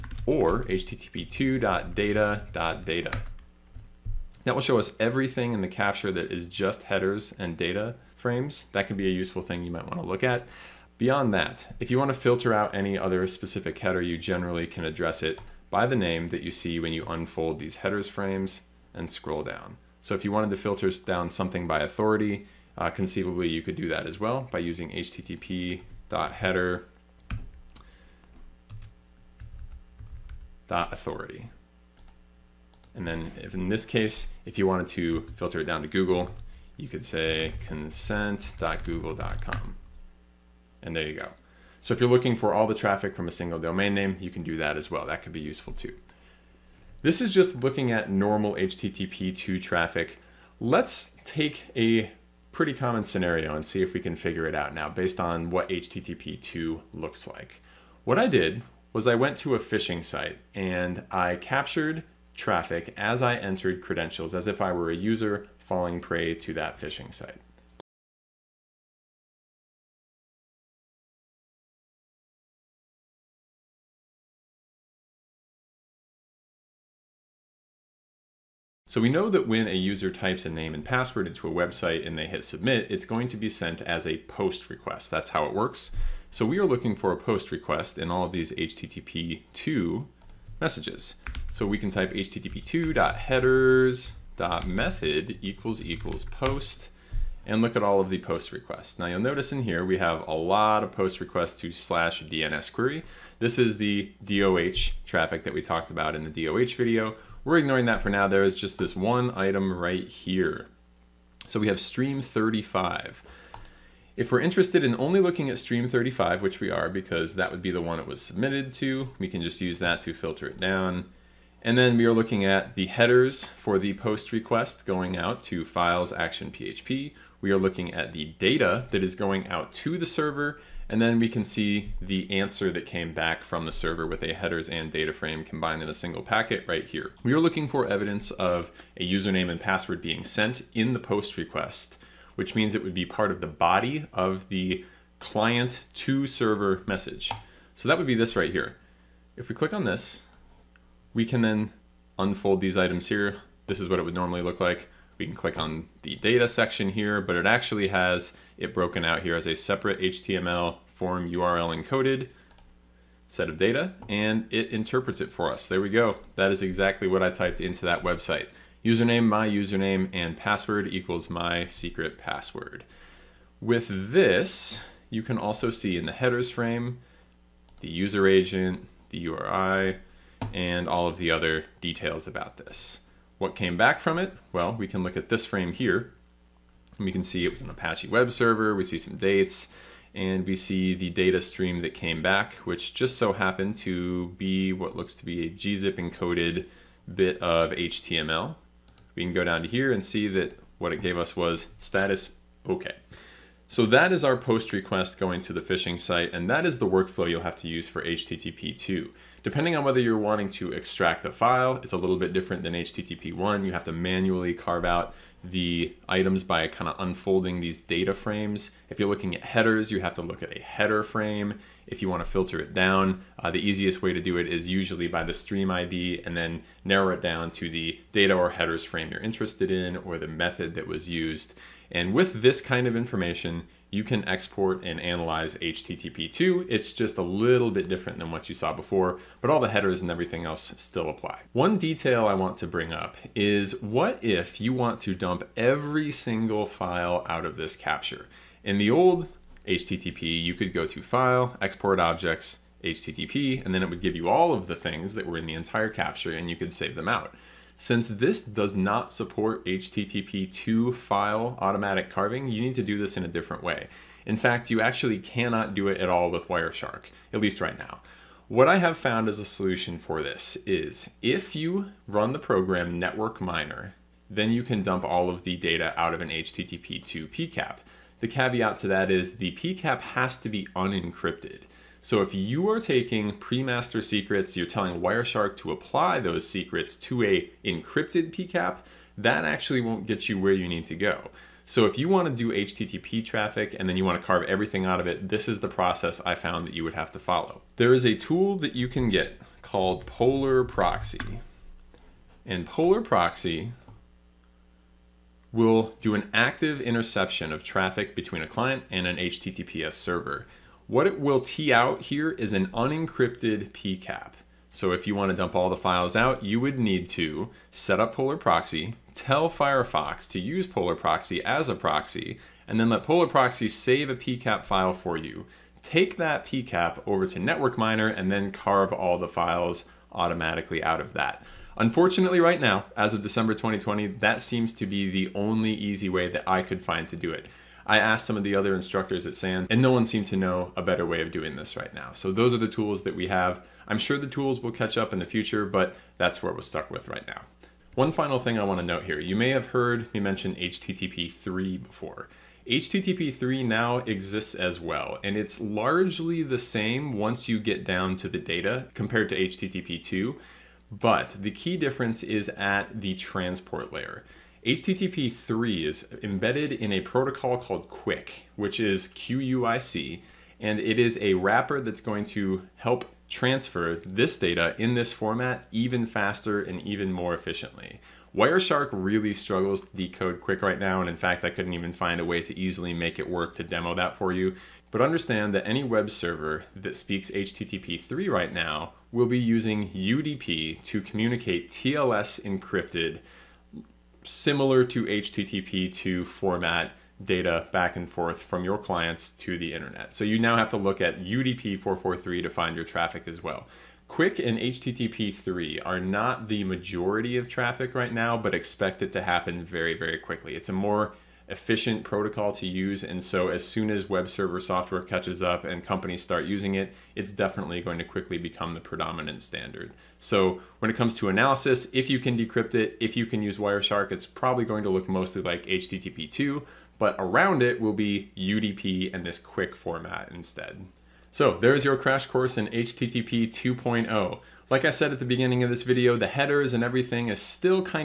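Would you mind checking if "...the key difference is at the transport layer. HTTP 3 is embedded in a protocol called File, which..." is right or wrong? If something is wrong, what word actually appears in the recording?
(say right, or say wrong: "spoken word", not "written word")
wrong: "Quick", not "File".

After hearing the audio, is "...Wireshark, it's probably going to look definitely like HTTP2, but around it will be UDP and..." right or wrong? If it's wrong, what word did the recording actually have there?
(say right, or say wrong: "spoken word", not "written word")
wrong: "mostly", not "definitely".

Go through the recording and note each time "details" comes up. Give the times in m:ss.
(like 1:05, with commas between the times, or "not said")
3:01, 4:01.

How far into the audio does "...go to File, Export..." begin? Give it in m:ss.
4:10.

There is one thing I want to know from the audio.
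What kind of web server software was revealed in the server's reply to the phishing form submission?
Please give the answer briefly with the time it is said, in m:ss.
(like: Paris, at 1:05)
Apache, at 3:07.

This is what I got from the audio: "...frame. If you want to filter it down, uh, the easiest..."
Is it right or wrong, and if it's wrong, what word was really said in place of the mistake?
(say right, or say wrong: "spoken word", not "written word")
right.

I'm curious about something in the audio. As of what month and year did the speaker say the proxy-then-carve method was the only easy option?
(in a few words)
December 2020.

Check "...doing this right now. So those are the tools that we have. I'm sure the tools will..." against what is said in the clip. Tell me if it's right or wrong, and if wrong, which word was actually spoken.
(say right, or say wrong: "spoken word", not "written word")
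right.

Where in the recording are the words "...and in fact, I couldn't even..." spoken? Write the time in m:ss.
6:20.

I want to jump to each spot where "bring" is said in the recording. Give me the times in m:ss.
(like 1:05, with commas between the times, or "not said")
4:02.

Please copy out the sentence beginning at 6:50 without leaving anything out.
It's a more efficient protocol to use.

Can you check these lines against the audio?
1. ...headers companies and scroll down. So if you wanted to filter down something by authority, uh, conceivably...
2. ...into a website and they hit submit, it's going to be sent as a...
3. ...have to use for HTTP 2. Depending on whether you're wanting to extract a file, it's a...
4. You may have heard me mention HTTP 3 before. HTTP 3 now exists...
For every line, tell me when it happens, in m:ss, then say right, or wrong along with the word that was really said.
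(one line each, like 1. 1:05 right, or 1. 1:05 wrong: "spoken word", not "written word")
1. 0:17 wrong: "frames", not "companies"
2. 1:21 right
3. 3:27 right
4. 5:49 right.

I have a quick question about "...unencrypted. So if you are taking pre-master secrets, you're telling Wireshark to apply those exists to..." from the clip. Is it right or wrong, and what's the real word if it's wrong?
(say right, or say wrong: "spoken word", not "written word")
wrong: "secrets", not "exists".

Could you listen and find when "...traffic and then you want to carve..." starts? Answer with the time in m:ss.
4:53.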